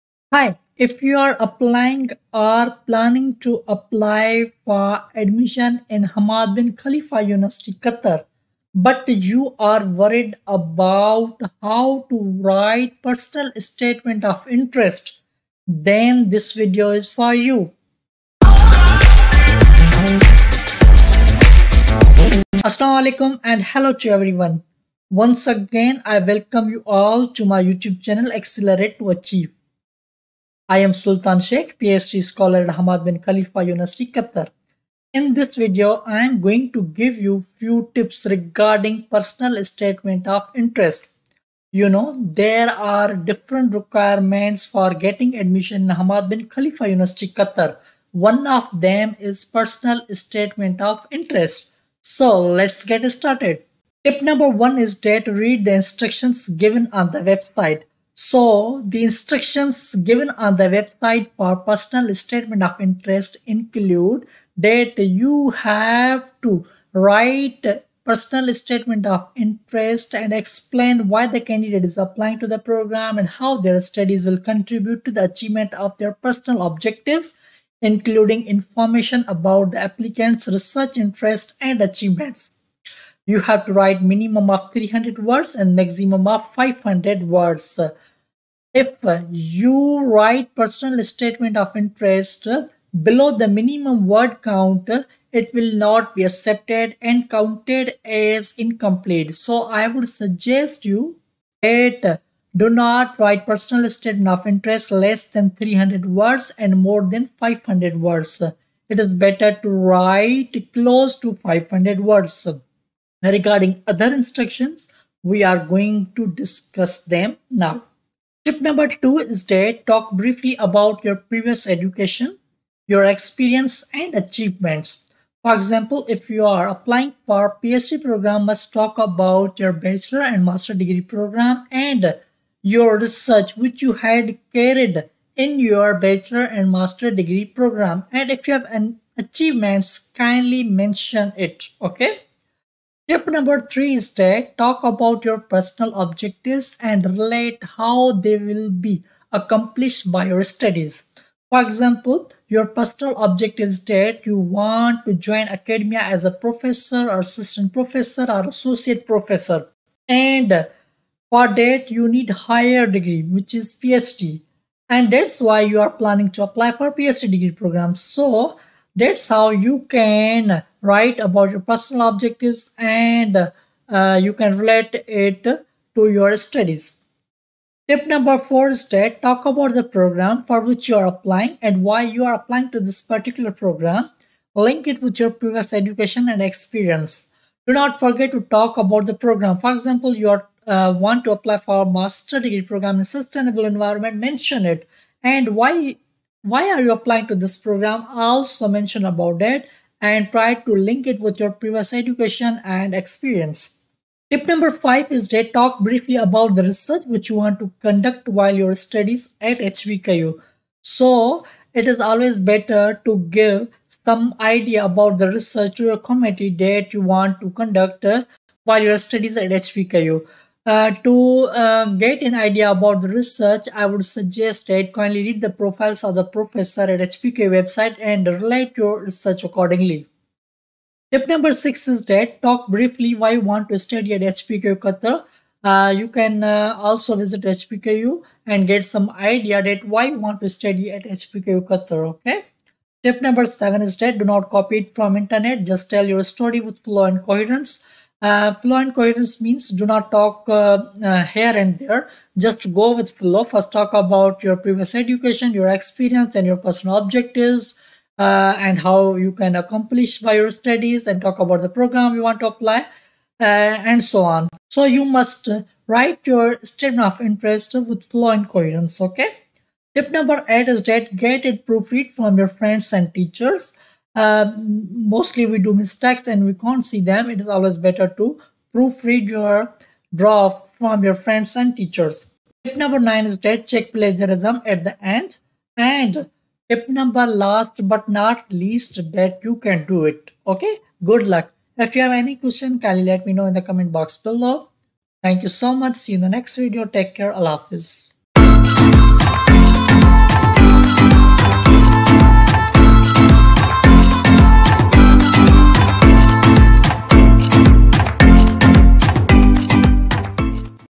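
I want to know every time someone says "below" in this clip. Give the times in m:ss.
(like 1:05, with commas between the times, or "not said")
1:33, 4:54.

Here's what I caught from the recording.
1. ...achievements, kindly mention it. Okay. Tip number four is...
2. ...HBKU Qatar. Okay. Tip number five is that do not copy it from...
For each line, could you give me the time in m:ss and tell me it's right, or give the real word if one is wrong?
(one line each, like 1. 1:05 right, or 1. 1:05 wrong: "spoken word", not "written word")
1. 2:19 wrong: "three", not "four"
2. 4:01 wrong: "seven", not "five".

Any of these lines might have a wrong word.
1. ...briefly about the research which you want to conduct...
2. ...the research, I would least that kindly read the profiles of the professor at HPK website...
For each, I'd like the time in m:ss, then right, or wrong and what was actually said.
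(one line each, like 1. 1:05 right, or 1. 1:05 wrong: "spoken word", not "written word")
1. 3:25 right
2. 3:43 wrong: "suggest", not "least".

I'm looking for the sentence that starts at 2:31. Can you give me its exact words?
For example, your personal objective is that you want to join academia as a professor or assistant professor or associate professor.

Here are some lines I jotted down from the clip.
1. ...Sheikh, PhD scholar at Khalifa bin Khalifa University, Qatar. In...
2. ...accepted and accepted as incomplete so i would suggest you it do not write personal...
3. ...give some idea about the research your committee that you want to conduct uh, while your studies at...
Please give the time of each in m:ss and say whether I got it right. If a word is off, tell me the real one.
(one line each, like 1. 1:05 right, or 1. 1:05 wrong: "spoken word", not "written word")
1. 0:31 wrong: "Hamad", not "Khalifa"
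2. 1:36 wrong: "counted", not "accepted"
3. 3:33 right.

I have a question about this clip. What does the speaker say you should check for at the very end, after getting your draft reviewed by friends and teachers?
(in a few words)
plagiarism.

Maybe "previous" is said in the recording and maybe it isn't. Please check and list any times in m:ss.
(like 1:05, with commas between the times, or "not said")
2:01, 3:05, 3:21, 4:14.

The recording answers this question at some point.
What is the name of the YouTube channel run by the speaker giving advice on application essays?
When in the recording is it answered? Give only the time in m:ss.
0:28.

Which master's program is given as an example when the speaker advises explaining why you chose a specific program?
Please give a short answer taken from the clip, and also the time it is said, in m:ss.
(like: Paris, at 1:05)
sustainable environment, at 3:13.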